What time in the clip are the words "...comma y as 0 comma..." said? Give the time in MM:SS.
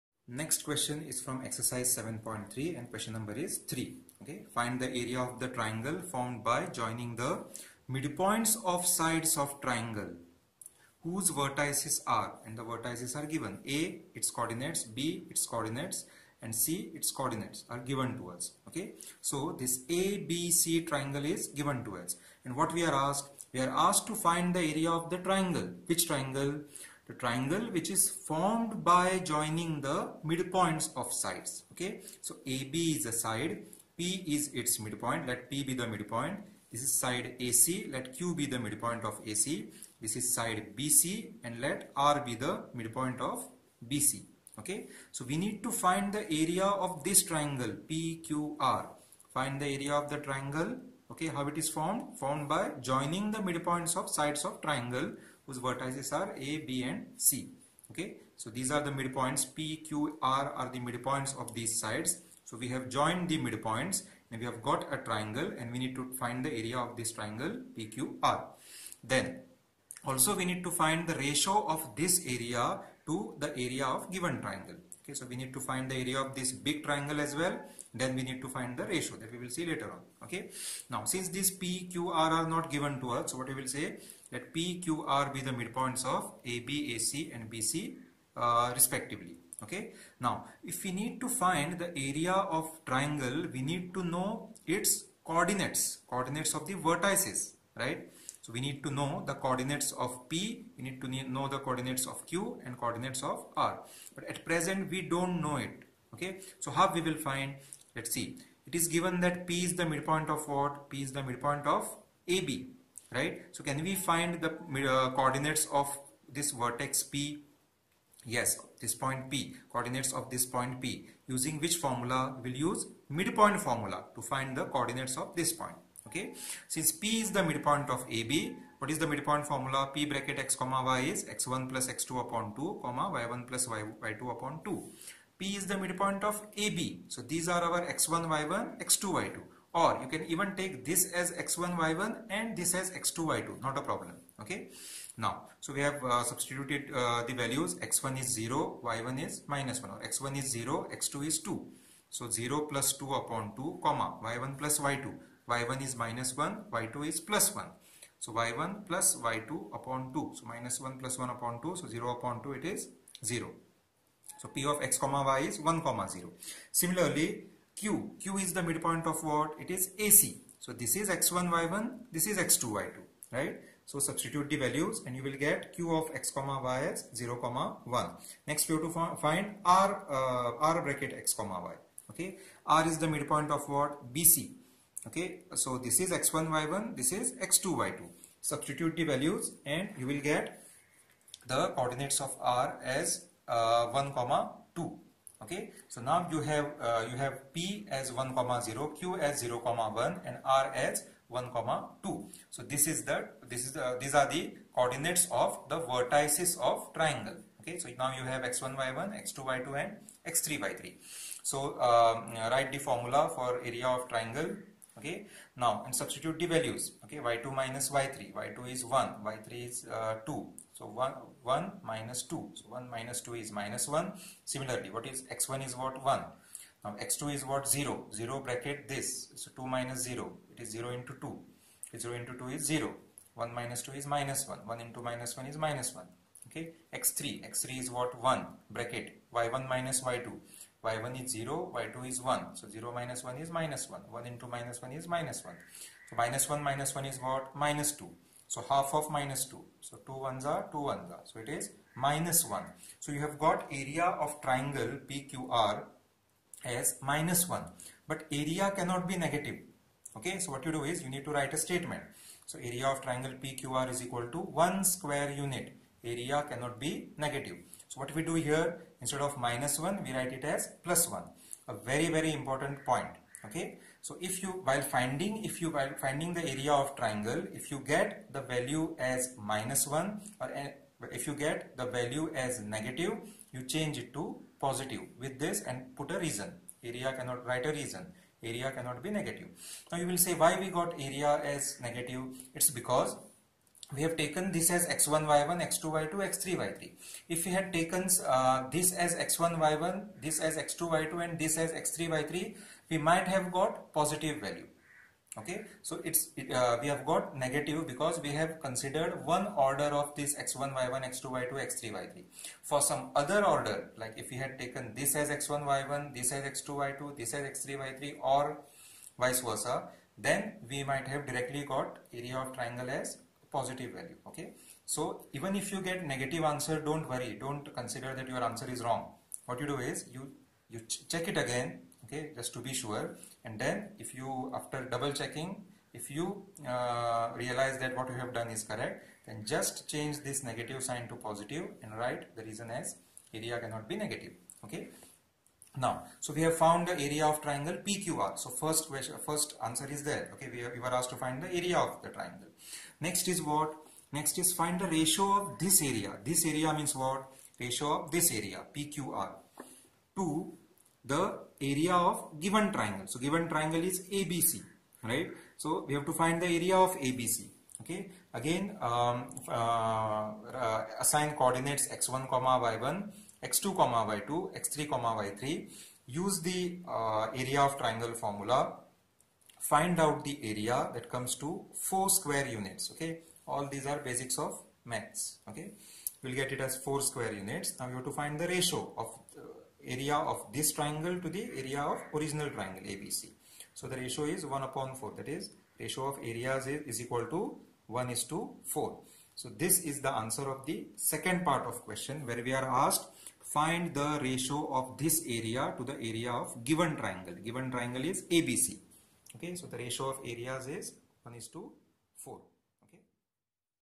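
02:56.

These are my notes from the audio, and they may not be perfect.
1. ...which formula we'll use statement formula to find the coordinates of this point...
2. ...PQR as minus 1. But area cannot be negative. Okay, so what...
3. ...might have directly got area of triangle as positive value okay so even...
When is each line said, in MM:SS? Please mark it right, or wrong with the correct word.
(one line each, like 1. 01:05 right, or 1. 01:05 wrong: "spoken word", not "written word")
1. 02:01 wrong: "midpoint", not "statement"
2. 04:15 right
3. 05:20 right.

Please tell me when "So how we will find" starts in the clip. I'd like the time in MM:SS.
01:46.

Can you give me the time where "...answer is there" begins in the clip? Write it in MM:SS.
05:49.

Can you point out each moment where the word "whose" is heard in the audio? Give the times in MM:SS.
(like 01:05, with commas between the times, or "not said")
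00:11, 00:55.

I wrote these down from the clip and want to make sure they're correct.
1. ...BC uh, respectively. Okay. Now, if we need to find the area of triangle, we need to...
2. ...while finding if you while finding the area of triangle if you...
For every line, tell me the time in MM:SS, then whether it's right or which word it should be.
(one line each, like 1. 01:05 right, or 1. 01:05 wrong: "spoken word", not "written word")
1. 01:27 right
2. 04:34 right.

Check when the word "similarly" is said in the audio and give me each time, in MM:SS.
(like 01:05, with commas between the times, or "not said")
02:46, 03:44.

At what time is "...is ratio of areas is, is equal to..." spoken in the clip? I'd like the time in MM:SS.
06:35.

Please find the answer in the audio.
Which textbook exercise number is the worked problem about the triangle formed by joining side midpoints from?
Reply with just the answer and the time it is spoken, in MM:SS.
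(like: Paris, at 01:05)
7.3, at 00:01.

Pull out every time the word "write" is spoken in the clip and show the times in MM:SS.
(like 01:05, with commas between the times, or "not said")
03:32, 04:21, 04:30, 04:47, 05:41.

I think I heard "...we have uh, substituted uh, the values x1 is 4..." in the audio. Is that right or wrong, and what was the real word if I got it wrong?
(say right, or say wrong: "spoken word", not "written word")
wrong: "0", not "4".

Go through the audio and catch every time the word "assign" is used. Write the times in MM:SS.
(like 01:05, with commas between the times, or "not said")
06:10.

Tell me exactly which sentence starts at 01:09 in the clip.
Then also we need to find the ratio of this area to the area of given triangle.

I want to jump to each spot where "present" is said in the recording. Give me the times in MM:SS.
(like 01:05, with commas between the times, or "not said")
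01:44.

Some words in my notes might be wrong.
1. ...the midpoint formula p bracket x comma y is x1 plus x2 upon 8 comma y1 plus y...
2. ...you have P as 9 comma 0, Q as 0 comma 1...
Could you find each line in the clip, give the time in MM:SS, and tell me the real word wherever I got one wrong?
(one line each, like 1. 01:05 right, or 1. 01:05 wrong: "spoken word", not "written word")
1. 02:08 wrong: "2", not "8"
2. 03:17 wrong: "1", not "9".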